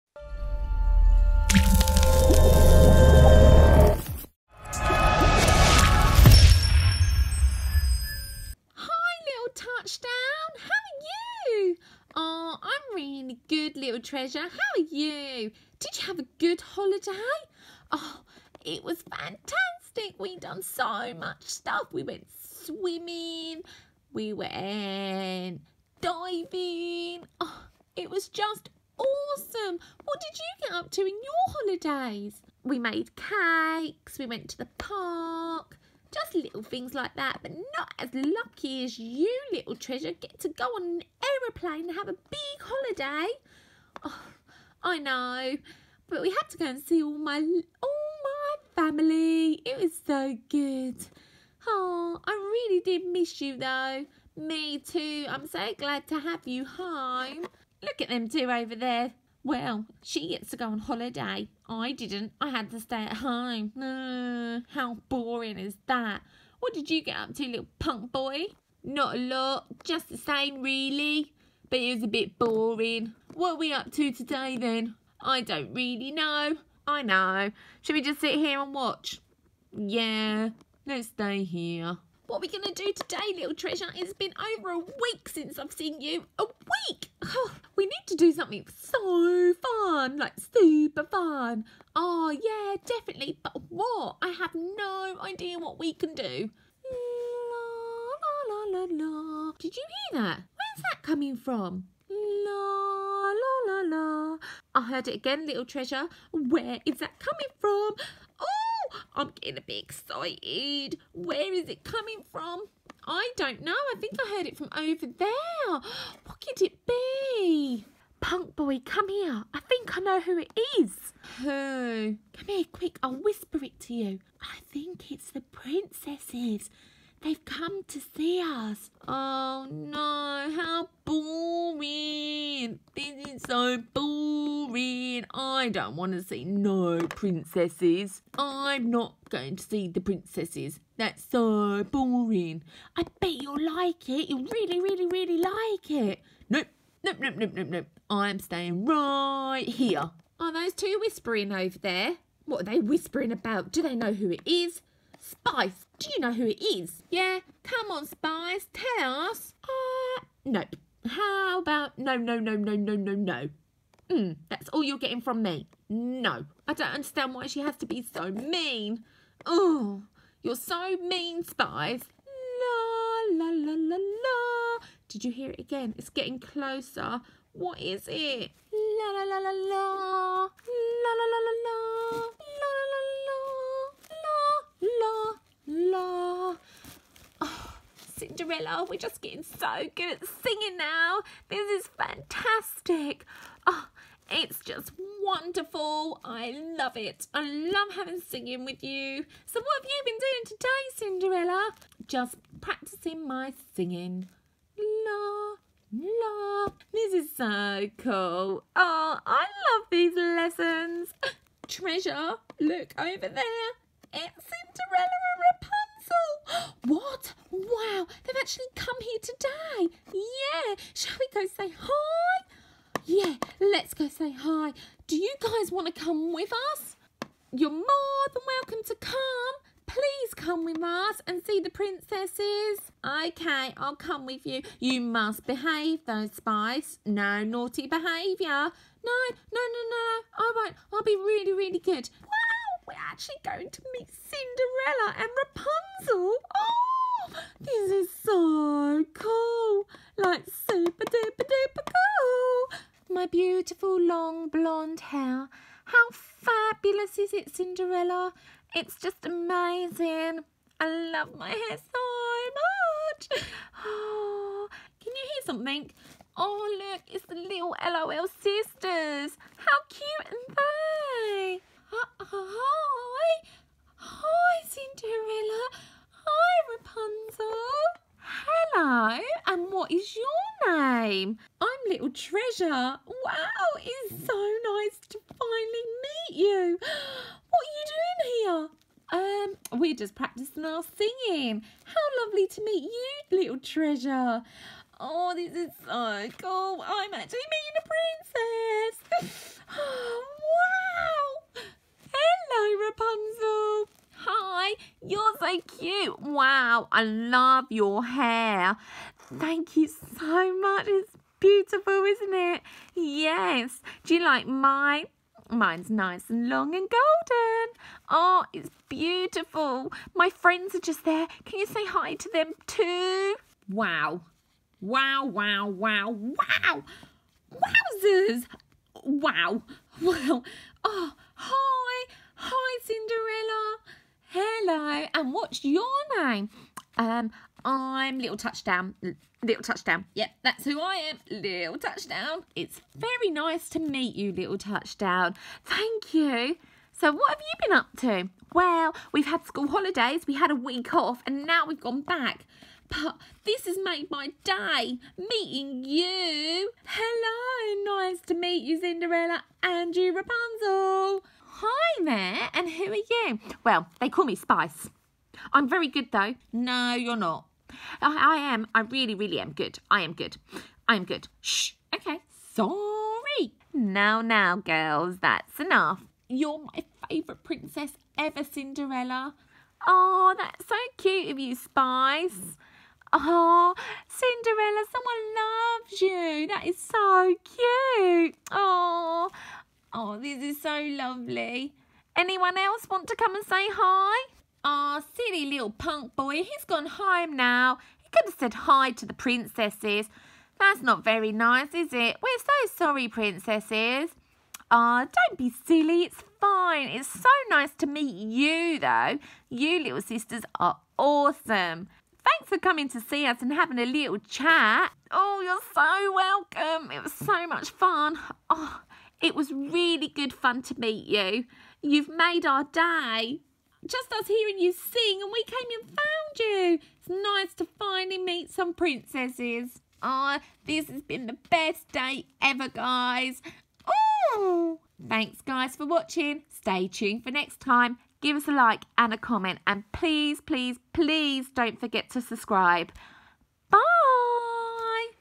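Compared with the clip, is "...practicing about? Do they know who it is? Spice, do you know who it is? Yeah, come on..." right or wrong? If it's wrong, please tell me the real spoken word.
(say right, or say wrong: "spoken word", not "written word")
wrong: "whispering", not "practicing".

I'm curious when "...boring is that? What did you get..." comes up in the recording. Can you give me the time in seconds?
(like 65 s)
65 s.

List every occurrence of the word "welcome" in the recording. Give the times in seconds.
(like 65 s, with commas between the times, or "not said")
228 s, 416 s.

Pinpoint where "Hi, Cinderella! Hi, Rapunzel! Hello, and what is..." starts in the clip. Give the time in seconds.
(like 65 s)
273 s.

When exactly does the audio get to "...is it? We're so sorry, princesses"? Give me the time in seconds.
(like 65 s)
401 s.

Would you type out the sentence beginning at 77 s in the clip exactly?
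Should we just sit here and watch?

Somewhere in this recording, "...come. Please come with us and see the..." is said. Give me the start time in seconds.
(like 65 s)
228 s.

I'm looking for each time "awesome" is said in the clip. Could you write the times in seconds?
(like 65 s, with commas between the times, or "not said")
28 s, 410 s.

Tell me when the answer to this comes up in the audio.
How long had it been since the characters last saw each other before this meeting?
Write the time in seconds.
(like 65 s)
84 s.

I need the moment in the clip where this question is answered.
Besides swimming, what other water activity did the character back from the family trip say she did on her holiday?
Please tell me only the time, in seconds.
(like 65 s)
24 s.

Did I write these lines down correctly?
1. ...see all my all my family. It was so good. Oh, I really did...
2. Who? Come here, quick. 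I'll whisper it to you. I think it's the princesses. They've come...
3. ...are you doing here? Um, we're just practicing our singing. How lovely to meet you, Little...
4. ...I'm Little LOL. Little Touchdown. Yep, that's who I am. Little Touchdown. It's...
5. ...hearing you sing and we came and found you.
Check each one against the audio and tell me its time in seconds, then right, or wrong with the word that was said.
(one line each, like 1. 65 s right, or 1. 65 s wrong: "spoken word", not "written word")
1. 46 s right
2. 121 s right
3. 287 s right
4. 337 s wrong: "Touchdown", not "LOL"
5. 424 s right.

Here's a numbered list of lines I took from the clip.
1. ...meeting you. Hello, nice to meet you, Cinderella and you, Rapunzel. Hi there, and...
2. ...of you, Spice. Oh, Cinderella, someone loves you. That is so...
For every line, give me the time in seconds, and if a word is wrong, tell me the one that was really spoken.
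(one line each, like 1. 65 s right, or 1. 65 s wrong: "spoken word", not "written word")
1. 355 s right
2. 381 s right.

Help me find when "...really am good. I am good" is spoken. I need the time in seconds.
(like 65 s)
369 s.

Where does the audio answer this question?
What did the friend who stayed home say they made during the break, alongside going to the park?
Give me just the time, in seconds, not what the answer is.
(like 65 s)
32 s.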